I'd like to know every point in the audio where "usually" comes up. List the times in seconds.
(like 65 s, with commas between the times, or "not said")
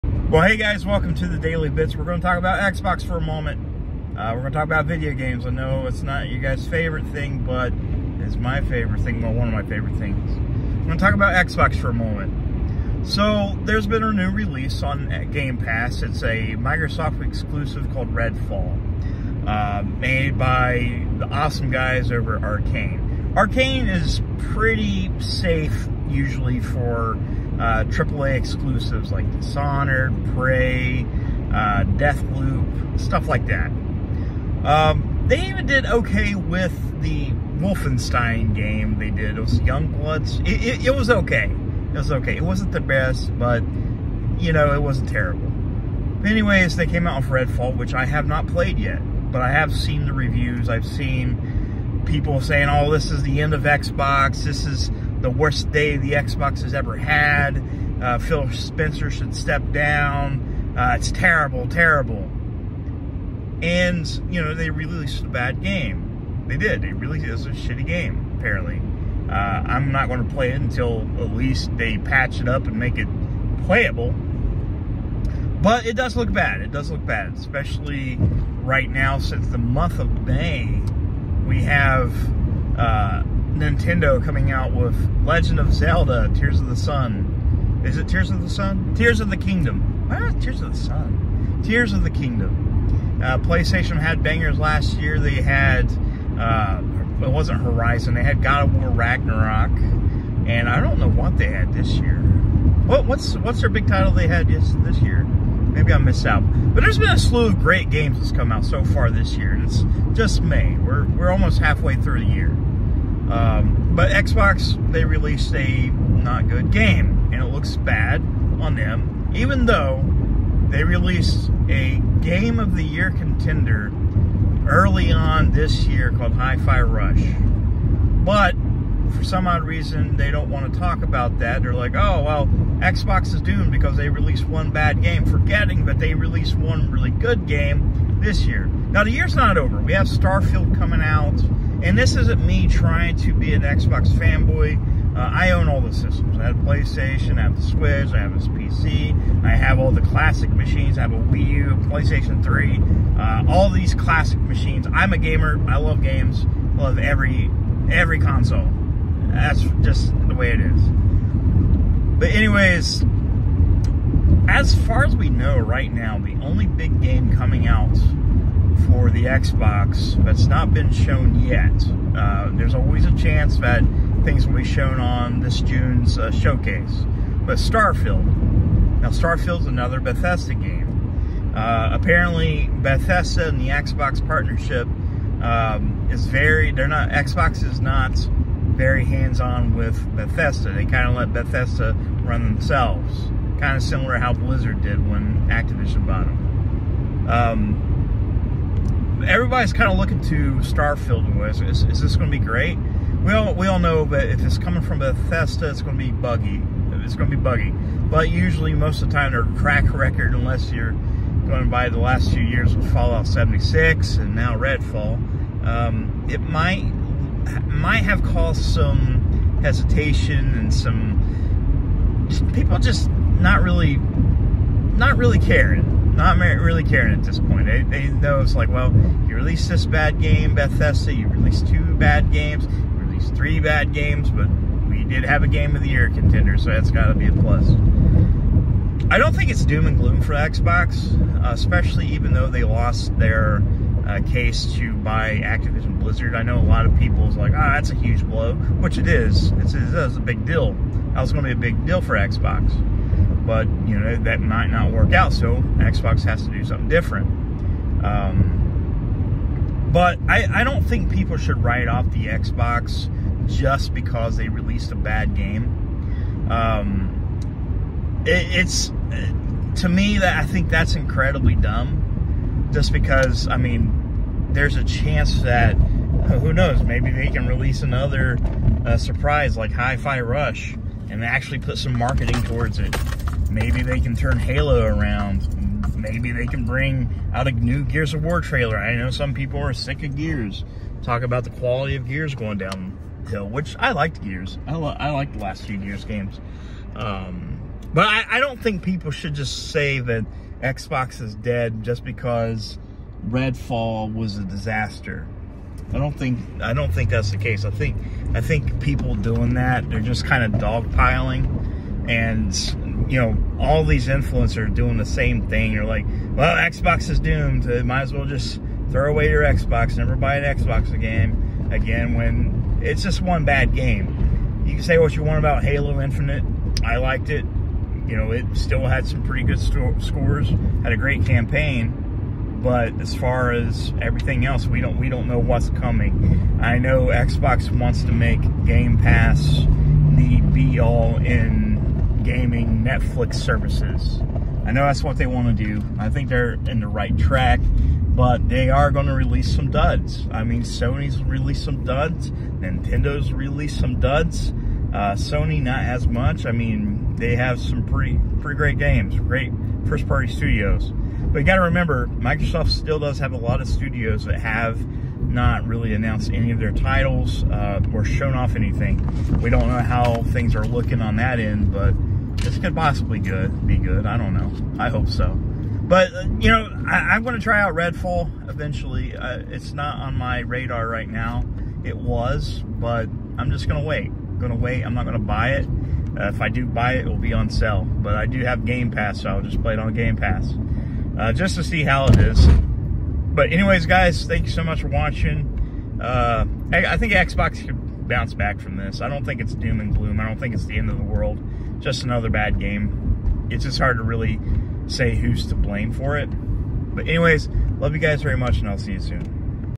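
26 s, 208 s.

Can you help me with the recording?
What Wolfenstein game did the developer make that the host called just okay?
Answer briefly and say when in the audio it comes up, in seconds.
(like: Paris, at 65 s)
Youngbloods, at 39 s.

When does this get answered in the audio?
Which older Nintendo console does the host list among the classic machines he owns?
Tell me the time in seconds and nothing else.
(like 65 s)
151 s.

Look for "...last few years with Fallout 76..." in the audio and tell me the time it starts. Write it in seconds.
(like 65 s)
211 s.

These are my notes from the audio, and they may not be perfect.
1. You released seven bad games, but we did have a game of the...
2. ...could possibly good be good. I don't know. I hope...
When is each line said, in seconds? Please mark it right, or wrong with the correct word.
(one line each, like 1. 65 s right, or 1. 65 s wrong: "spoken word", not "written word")
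1. 232 s wrong: "three", not "seven"
2. 372 s right.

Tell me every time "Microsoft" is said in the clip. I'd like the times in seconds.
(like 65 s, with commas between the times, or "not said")
16 s, 362 s.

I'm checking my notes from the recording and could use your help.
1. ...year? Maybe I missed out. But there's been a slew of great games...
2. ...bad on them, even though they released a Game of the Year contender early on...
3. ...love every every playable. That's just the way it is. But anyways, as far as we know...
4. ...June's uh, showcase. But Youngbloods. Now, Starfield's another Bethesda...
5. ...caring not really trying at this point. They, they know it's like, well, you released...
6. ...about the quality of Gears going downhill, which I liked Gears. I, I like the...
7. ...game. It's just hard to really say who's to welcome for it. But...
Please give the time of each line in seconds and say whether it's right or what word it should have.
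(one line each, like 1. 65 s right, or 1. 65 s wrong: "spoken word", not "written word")
1. 104 s right
2. 117 s right
3. 156 s wrong: "console", not "playable"
4. 175 s wrong: "Starfield", not "Youngbloods"
5. 225 s wrong: "caring", not "trying"
6. 291 s right
7. 402 s wrong: "blame", not "welcome".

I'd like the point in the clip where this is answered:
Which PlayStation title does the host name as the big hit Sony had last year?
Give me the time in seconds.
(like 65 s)
98 s.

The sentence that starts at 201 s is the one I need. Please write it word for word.
Is, is, is this going to be great?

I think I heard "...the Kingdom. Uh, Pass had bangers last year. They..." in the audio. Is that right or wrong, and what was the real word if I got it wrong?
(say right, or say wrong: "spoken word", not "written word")
wrong: "PlayStation", not "Pass".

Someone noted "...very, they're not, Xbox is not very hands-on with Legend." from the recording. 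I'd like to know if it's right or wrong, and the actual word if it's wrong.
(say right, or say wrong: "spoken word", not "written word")
wrong: "Bethesda", not "Legend".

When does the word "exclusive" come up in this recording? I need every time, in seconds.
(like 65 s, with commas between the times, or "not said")
17 s, 28 s.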